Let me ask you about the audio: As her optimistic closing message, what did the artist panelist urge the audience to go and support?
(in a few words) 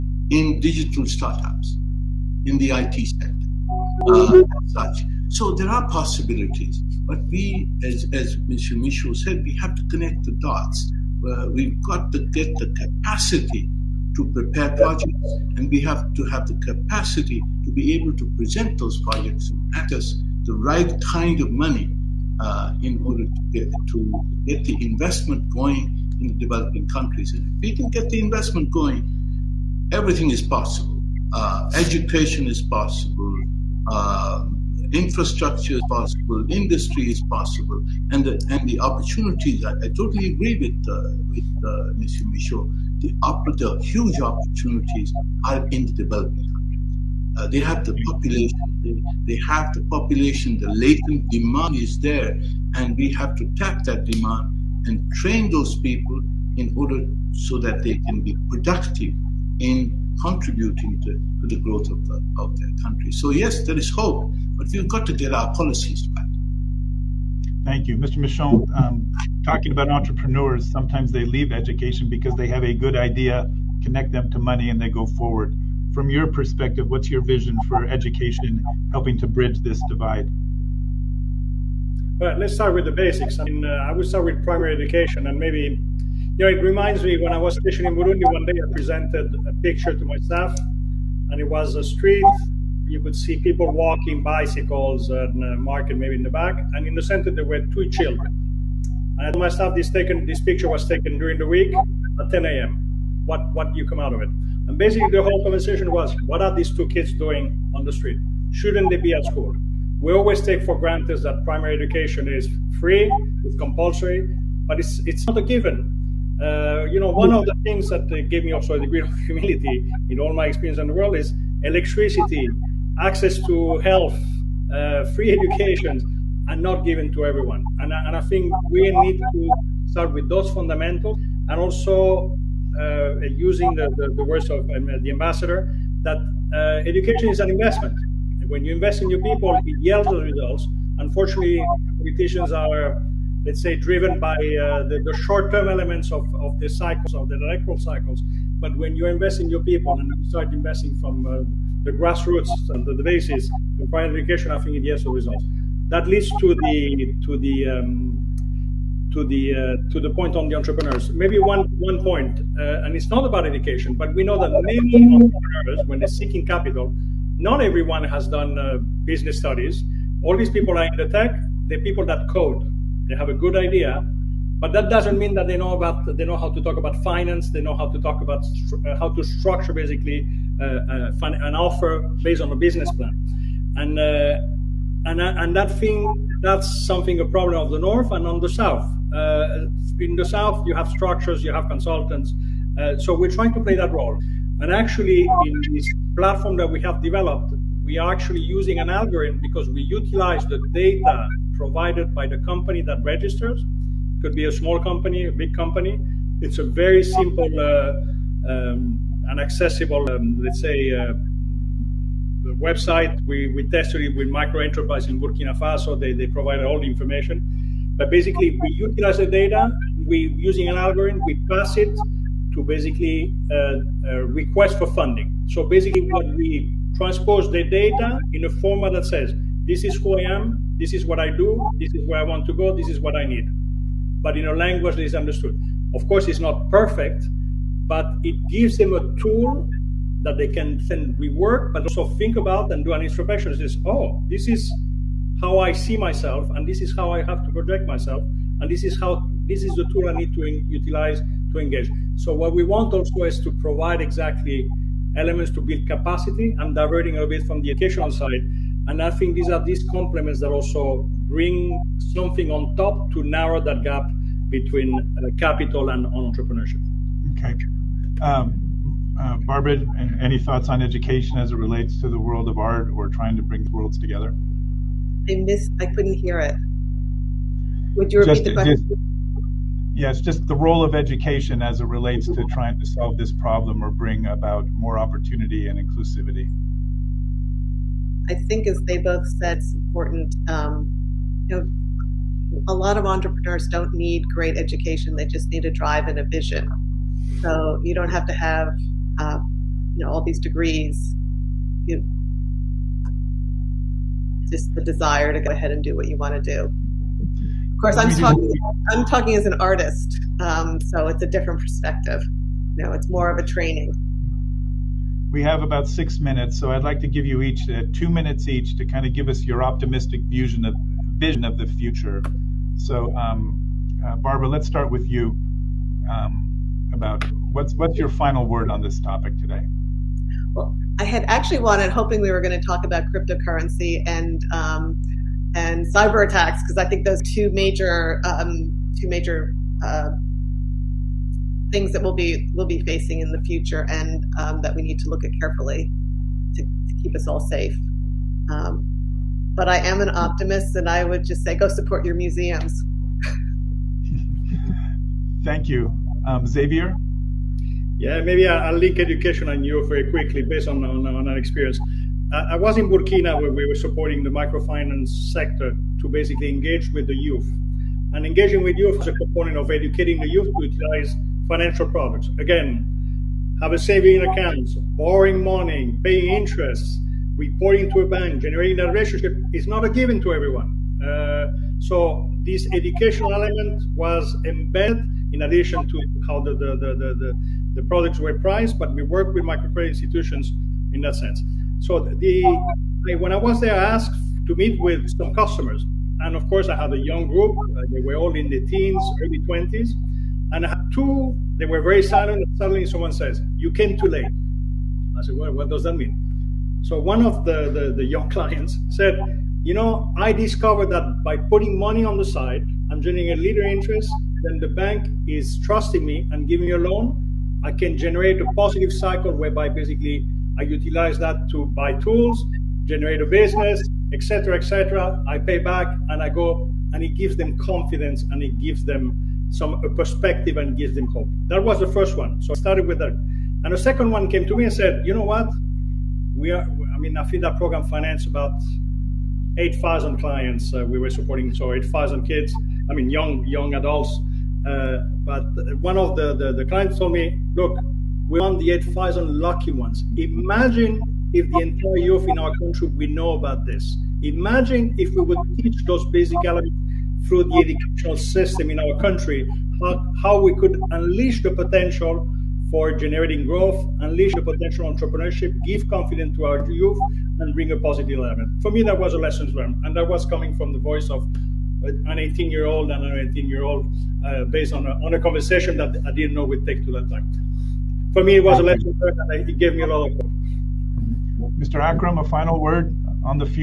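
Museums.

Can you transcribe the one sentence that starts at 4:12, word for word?
So what we want also is to provide exactly elements to build capacity.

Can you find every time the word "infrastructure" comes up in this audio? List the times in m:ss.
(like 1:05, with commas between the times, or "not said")
0:34.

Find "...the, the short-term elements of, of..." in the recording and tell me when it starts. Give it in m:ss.
2:24.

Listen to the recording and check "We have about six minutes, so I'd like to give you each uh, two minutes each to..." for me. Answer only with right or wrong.
right.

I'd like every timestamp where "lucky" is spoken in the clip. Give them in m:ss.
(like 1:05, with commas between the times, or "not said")
7:29.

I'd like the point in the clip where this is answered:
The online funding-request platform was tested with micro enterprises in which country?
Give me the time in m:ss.
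3:35.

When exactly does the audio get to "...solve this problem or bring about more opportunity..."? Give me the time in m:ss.
4:42.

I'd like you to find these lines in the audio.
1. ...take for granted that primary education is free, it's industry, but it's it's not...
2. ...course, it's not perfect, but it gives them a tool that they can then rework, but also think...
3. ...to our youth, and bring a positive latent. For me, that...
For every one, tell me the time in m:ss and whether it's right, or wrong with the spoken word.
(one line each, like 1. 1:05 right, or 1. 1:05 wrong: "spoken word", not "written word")
1. 1:50 wrong: "compulsory", not "industry"
2. 3:56 right
3. 7:46 wrong: "element", not "latent".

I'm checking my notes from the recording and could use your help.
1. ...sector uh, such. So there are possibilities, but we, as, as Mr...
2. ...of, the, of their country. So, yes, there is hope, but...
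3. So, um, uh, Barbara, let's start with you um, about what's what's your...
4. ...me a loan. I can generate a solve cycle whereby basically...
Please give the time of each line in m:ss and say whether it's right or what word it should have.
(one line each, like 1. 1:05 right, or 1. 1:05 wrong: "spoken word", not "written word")
1. 0:03 right
2. 1:01 right
3. 5:22 right
4. 6:56 wrong: "positive", not "solve".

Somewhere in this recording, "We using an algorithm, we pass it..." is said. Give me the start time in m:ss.
3:40.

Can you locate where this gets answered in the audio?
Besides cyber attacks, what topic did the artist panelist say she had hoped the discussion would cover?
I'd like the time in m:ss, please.
5:33.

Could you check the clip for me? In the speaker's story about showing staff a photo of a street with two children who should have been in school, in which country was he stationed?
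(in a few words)
Burundi.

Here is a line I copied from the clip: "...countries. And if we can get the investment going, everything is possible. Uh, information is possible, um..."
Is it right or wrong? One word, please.
wrong.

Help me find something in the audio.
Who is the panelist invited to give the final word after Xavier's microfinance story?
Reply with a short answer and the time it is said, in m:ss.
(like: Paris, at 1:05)
Mr. Akram, at 8:01.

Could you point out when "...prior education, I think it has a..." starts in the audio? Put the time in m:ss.
2:33.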